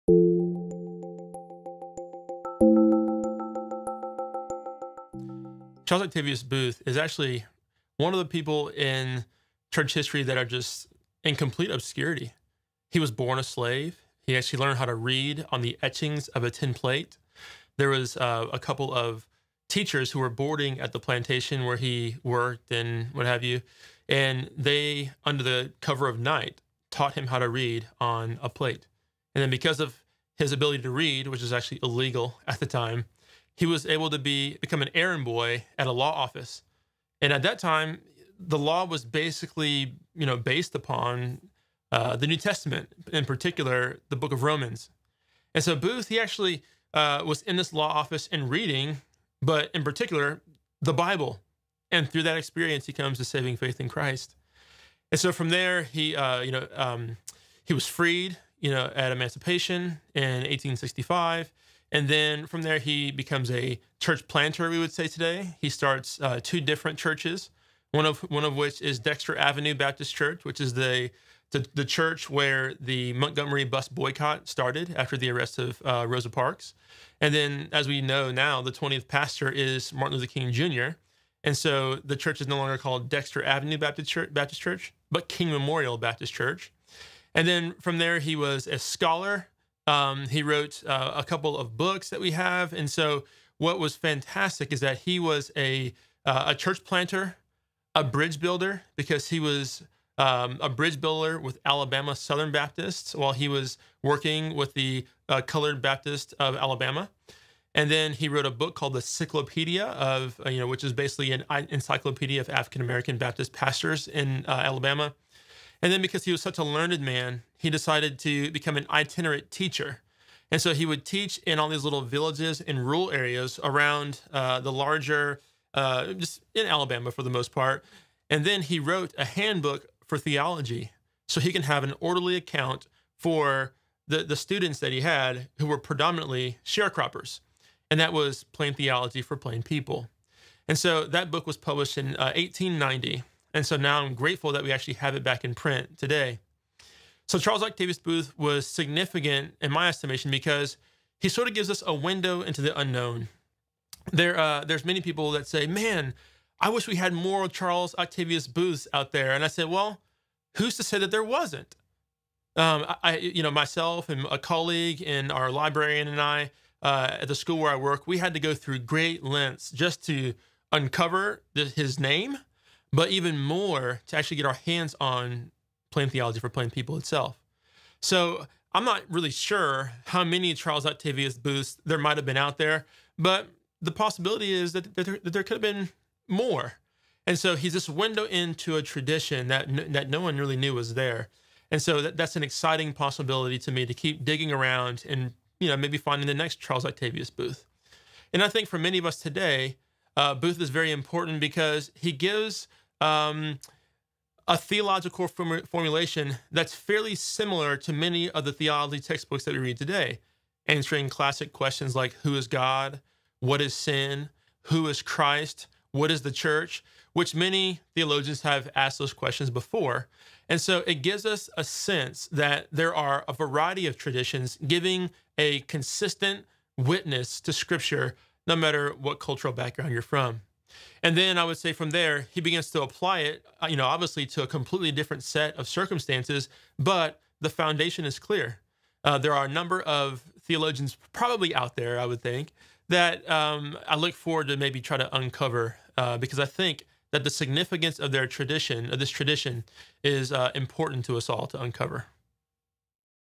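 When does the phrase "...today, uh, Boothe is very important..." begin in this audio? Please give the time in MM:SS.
03:19.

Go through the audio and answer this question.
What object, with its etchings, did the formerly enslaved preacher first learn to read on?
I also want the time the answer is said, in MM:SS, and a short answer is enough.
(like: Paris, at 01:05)
A tin plate, at 00:16.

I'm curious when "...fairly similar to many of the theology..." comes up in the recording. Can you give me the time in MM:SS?
03:26.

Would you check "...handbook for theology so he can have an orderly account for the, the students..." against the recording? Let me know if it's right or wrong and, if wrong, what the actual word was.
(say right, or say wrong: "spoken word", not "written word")
right.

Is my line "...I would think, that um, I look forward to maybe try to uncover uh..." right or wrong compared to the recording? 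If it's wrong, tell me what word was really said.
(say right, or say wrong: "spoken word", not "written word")
right.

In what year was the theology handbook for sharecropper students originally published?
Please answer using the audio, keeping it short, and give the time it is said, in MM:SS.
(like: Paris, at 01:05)
1890, at 02:22.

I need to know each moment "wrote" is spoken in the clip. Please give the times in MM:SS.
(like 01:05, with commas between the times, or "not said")
01:30, 01:48, 02:08.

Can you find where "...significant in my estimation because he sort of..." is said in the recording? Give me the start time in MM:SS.
02:28.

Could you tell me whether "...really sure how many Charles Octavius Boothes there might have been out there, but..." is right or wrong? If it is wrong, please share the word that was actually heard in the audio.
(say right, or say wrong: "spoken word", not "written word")
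right.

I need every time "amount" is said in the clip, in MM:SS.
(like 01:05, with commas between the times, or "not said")
not said.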